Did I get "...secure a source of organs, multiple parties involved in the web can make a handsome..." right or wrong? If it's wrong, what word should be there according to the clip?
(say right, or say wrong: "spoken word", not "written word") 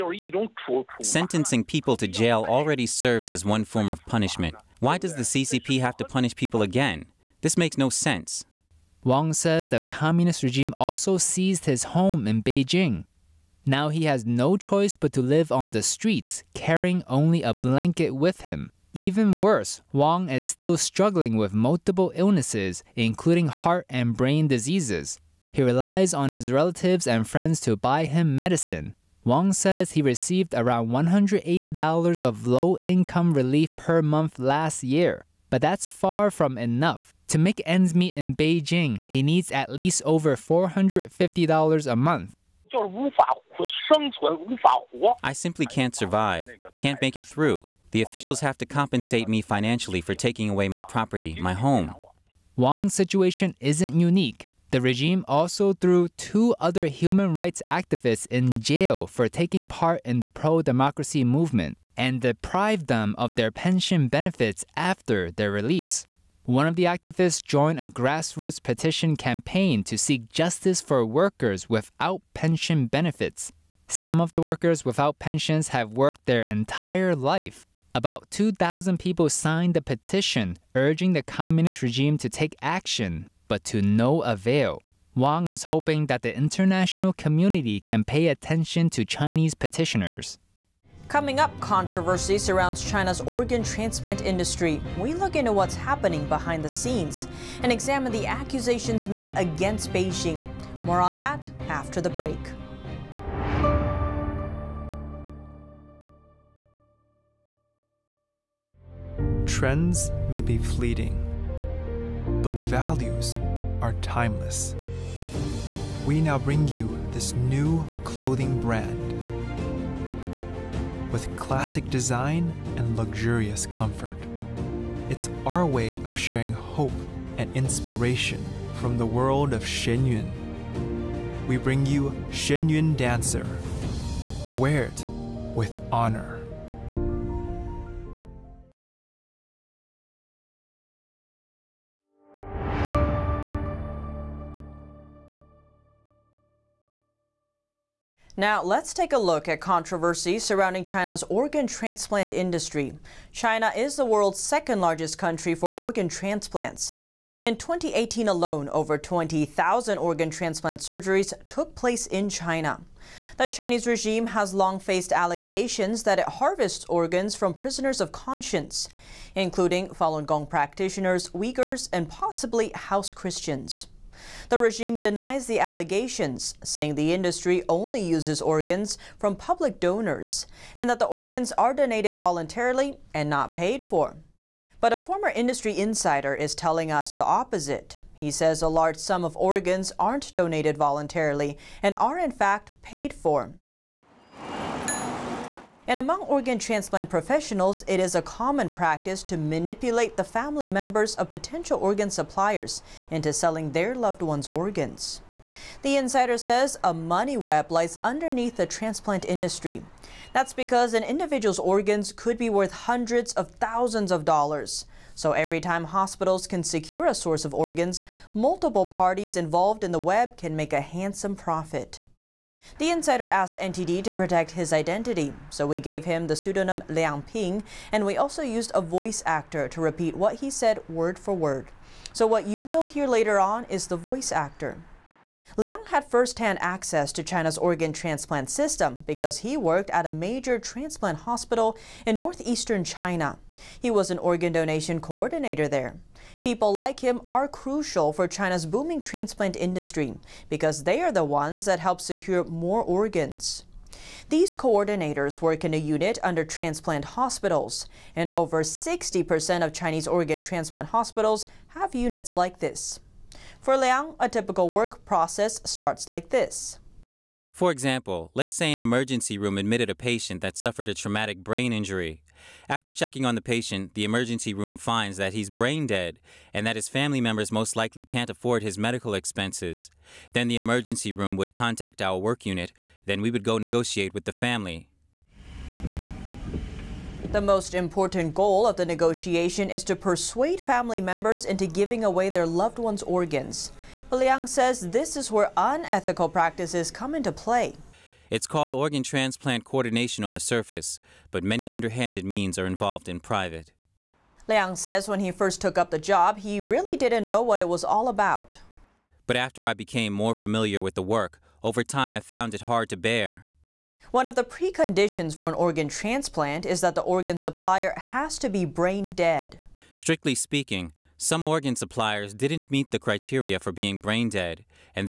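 right.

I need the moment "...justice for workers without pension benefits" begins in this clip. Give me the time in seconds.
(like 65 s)
70 s.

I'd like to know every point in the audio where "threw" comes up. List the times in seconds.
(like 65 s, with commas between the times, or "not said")
55 s.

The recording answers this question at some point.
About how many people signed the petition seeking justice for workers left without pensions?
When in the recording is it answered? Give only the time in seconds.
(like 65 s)
78 s.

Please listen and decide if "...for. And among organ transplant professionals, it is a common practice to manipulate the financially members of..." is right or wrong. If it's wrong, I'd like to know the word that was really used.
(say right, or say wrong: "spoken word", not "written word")
wrong: "family", not "financially".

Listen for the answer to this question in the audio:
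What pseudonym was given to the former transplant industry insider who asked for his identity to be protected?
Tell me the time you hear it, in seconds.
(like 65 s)
226 s.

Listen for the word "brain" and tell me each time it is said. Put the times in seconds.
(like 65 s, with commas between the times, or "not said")
24 s, 271 s, 275 s, 318 s, 323 s.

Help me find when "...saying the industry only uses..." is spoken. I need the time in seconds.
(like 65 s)
176 s.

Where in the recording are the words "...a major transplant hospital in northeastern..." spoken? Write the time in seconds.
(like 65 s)
240 s.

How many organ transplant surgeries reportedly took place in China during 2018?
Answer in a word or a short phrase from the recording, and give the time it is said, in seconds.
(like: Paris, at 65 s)
over 20,000, at 158 s.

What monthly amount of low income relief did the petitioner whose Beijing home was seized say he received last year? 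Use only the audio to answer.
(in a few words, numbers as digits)
$180.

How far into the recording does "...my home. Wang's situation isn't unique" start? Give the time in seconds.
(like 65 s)
51 s.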